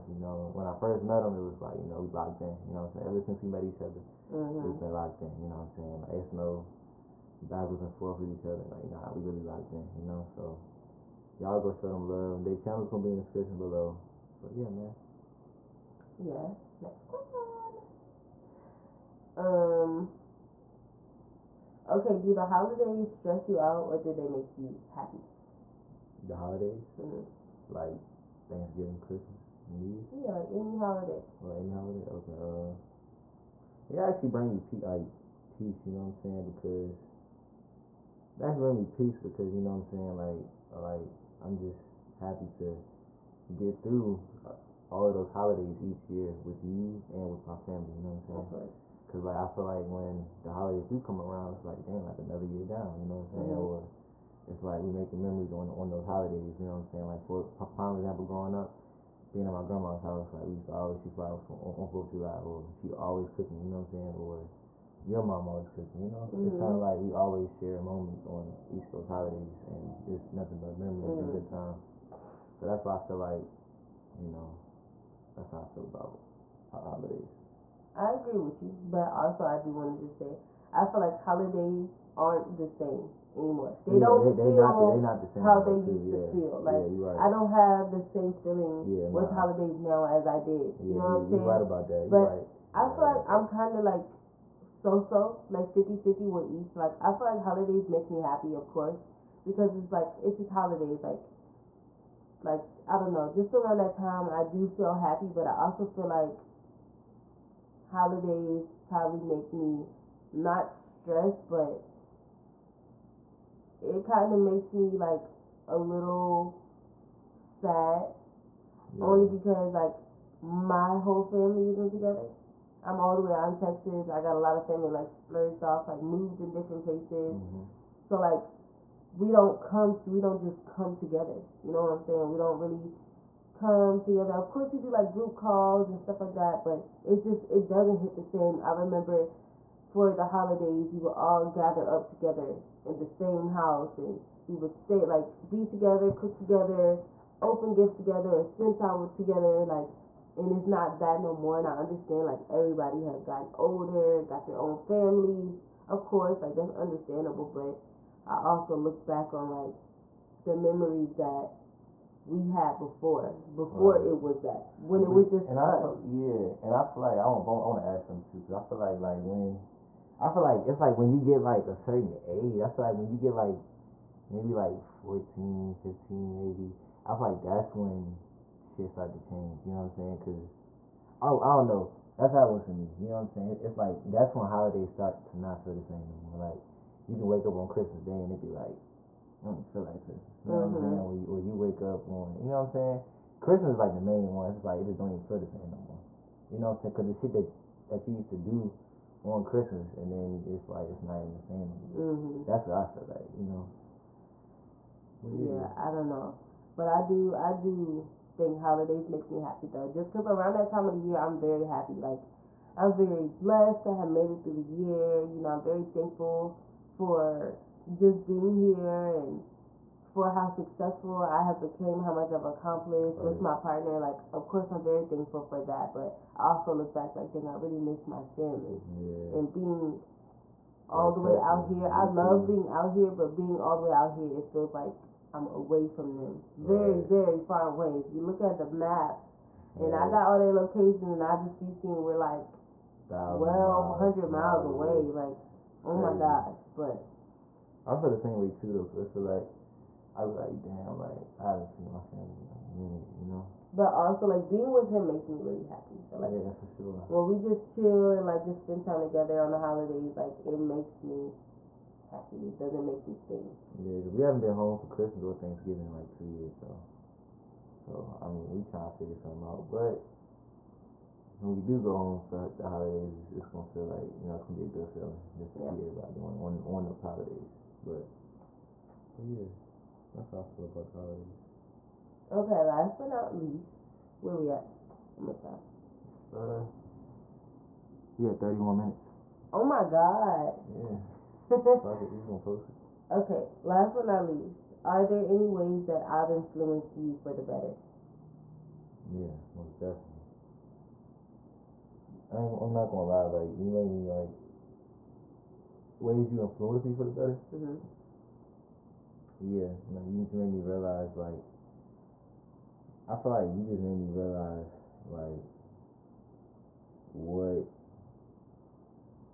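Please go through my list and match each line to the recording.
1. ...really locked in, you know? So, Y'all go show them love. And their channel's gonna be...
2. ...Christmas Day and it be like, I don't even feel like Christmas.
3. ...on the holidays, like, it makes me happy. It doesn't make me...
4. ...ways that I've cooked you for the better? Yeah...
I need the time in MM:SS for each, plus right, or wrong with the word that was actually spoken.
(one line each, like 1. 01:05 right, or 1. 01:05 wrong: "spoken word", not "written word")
1. 00:09 right
2. 03:07 right
3. 04:19 right
4. 04:55 wrong: "influenced", not "cooked".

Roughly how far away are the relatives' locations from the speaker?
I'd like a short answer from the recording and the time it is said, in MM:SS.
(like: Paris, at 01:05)
1,200 miles, at 04:03.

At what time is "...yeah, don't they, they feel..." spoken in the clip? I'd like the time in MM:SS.
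01:23.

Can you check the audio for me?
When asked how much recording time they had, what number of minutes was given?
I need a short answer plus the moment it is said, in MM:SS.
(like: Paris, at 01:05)
31 minutes, at 04:48.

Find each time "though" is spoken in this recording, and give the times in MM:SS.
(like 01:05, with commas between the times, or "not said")
03:29, 04:08.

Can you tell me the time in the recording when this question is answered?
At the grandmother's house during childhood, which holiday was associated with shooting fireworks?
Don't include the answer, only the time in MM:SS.
01:01.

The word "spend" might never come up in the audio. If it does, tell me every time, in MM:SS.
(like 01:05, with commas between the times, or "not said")
02:28, 04:18.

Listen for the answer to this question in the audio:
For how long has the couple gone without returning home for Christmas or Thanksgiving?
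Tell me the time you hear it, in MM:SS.
04:26.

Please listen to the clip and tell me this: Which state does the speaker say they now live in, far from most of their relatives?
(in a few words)
Texas.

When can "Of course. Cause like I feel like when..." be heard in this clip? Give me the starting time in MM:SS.
00:48.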